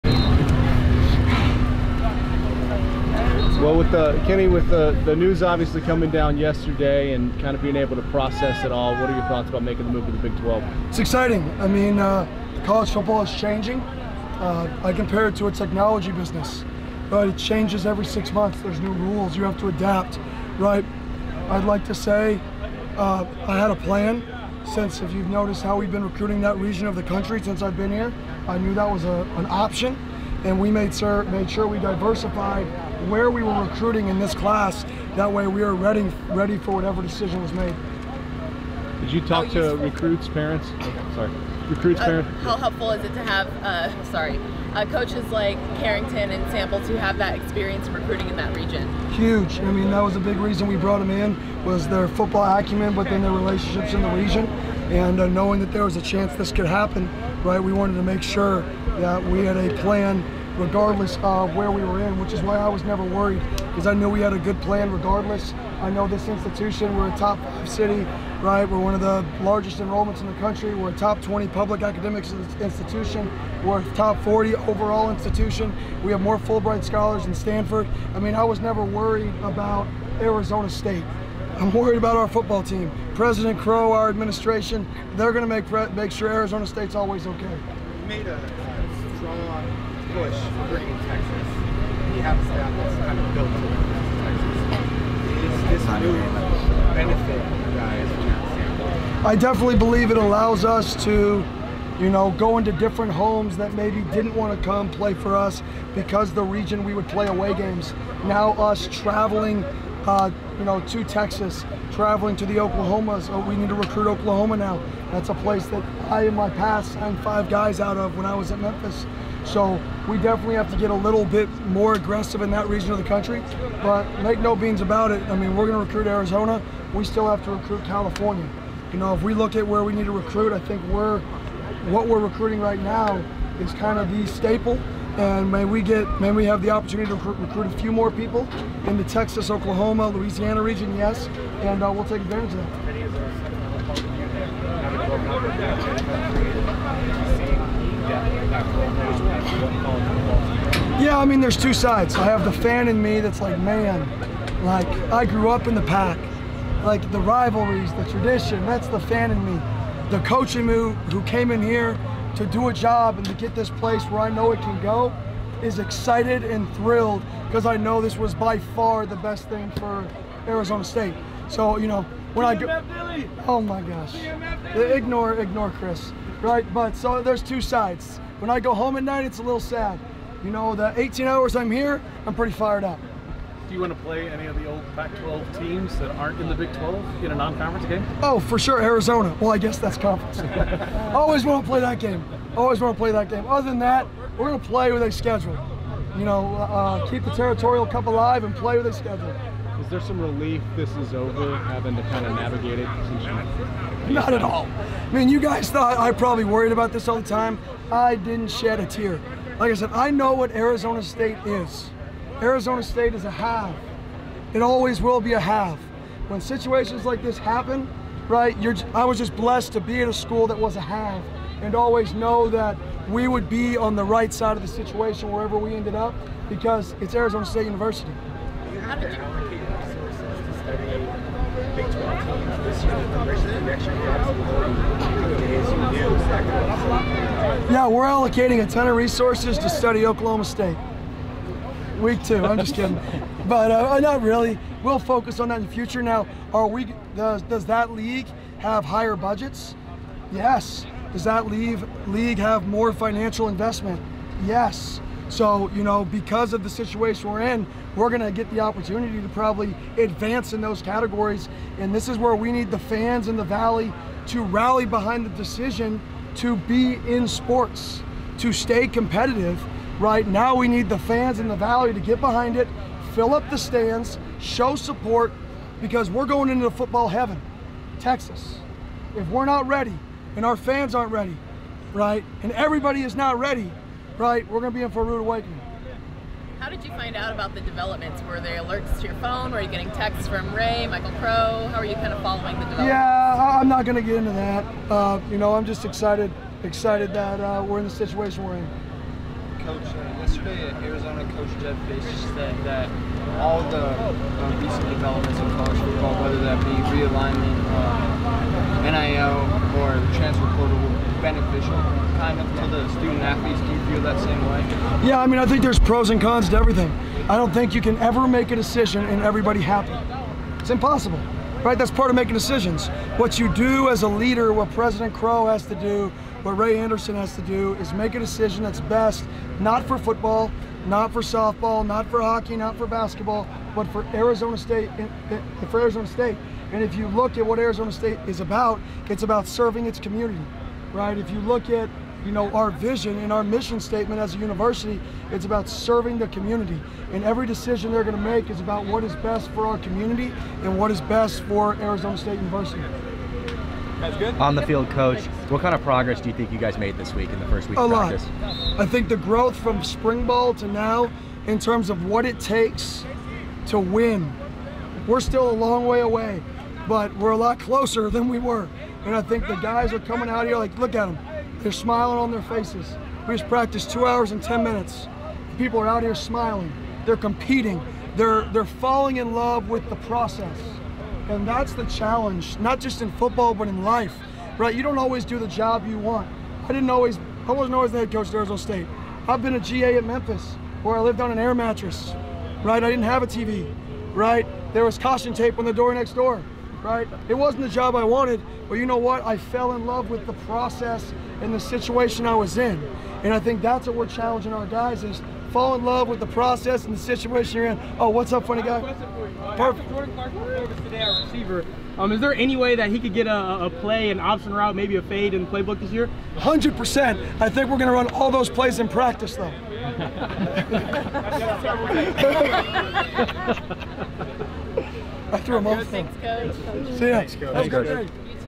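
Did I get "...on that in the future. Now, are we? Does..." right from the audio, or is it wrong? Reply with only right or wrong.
right.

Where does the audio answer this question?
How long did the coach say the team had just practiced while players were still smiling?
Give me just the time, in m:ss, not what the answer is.
6:13.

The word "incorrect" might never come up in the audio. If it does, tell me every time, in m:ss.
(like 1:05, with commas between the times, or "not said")
not said.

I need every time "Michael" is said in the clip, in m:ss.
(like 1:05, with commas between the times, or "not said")
4:50.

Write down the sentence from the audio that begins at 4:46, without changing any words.
How did you find out about the developments?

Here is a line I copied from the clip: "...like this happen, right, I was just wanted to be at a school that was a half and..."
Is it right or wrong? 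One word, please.
wrong.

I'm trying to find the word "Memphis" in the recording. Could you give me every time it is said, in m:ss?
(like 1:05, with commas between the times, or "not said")
1:58, 6:30.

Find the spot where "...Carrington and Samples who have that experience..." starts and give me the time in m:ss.
0:45.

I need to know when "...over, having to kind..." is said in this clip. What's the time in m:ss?
3:21.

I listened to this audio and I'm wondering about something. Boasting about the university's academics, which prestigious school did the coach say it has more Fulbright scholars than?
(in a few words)
Stanford.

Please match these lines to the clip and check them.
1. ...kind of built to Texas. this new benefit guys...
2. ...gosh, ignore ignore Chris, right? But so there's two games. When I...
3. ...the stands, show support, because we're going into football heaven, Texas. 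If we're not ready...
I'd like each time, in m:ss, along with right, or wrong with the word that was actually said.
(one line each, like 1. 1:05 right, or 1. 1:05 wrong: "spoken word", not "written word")
1. 1:33 right
2. 2:53 wrong: "sides", not "games"
3. 4:33 right.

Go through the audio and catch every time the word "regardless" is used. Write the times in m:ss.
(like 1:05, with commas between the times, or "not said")
1:00, 1:04.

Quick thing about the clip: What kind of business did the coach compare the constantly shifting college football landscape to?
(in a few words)
technology business.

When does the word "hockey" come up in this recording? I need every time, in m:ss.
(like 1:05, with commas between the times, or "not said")
5:32.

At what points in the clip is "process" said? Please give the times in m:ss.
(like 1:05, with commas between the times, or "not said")
0:08, 6:19, 6:40, 6:46.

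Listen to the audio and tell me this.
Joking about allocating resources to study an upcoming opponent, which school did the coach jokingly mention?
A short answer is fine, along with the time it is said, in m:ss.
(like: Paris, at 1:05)
Oklahoma State, at 4:00.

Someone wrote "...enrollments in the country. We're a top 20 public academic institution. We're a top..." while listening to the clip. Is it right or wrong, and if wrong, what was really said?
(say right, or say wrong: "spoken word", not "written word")
right.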